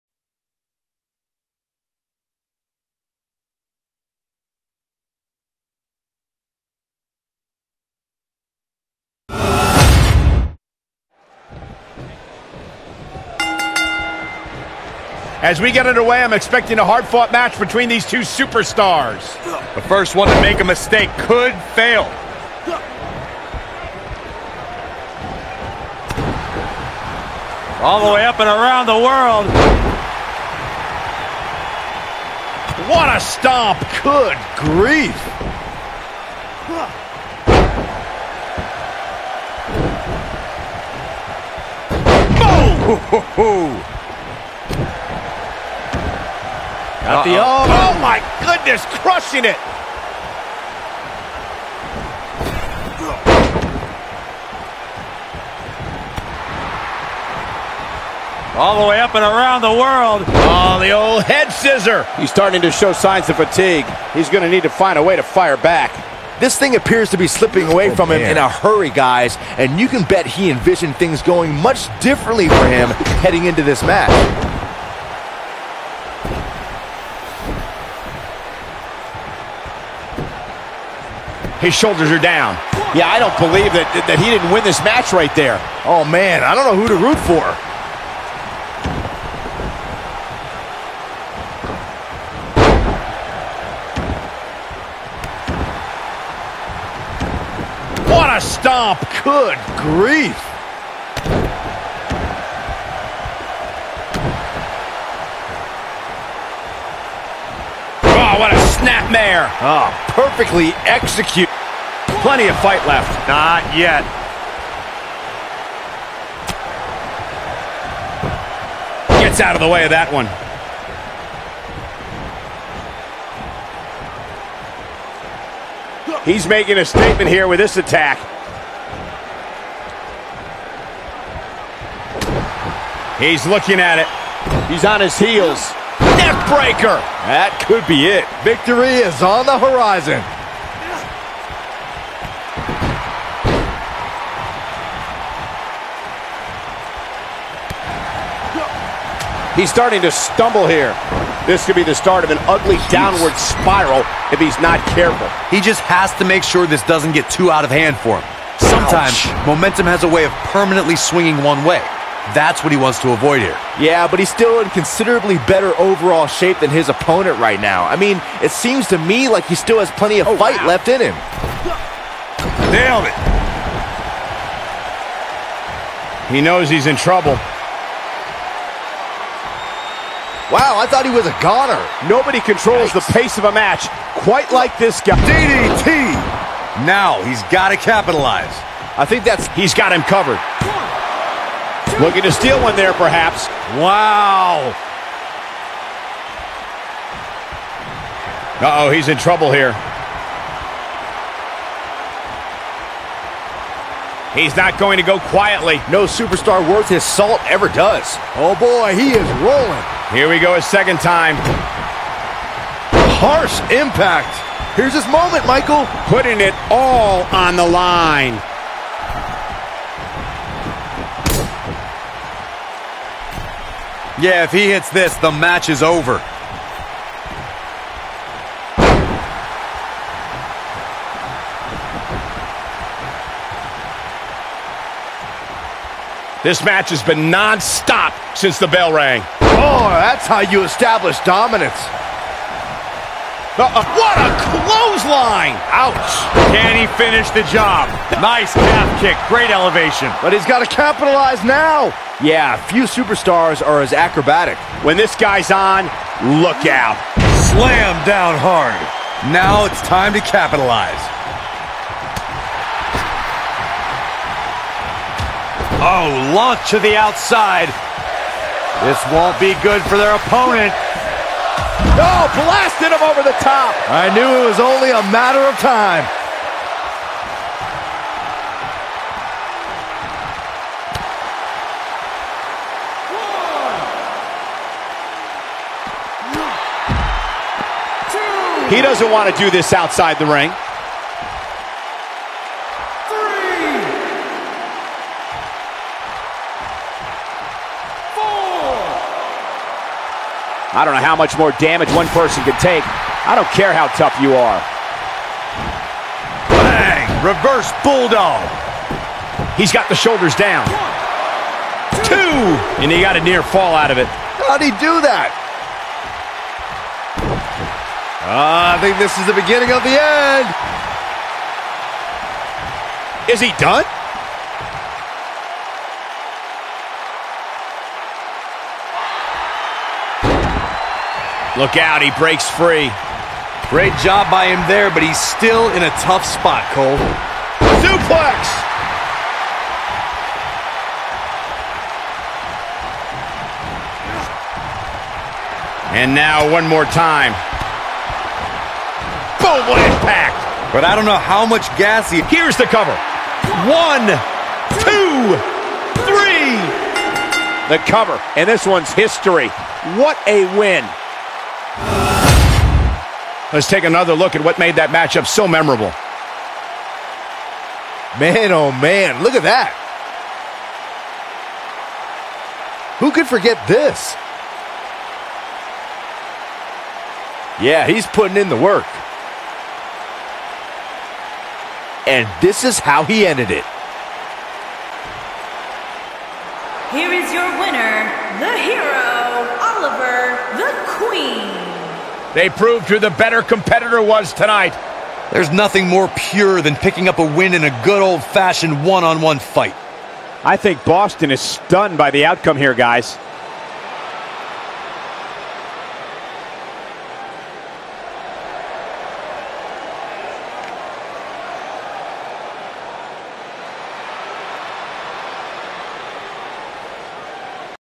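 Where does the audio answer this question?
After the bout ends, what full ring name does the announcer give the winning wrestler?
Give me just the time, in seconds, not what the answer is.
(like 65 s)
389 s.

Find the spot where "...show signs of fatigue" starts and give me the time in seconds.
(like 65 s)
62 s.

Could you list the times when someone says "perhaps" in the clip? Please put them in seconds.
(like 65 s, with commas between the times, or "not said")
192 s.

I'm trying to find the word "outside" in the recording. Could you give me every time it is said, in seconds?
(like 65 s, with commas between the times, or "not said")
266 s, 289 s.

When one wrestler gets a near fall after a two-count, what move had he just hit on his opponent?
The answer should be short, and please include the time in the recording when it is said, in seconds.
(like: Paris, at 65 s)
Reverse Bulldog, at 307 s.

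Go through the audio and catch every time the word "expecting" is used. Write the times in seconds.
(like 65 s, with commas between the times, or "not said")
16 s.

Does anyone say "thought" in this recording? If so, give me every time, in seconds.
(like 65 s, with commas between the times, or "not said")
180 s.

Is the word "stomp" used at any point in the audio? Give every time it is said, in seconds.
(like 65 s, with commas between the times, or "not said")
33 s, 98 s.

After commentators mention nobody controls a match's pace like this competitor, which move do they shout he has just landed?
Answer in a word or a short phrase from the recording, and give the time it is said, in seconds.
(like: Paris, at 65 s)
DDT, at 185 s.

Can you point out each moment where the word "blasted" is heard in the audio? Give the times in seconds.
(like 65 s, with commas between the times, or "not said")
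272 s.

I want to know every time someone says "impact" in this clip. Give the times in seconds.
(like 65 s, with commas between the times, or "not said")
213 s, 349 s.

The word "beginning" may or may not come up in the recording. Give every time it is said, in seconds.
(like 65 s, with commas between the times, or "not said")
319 s.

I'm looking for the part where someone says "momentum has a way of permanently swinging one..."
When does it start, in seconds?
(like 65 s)
159 s.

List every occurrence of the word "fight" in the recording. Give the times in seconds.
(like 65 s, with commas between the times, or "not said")
112 s, 170 s, 399 s.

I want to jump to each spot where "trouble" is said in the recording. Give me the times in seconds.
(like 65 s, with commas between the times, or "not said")
176 s, 199 s.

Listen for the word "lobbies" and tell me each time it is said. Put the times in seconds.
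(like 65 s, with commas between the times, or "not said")
not said.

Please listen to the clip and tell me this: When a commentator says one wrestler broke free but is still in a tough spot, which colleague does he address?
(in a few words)
Cole.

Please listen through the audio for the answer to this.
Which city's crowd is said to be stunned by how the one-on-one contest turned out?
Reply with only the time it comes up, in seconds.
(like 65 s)
400 s.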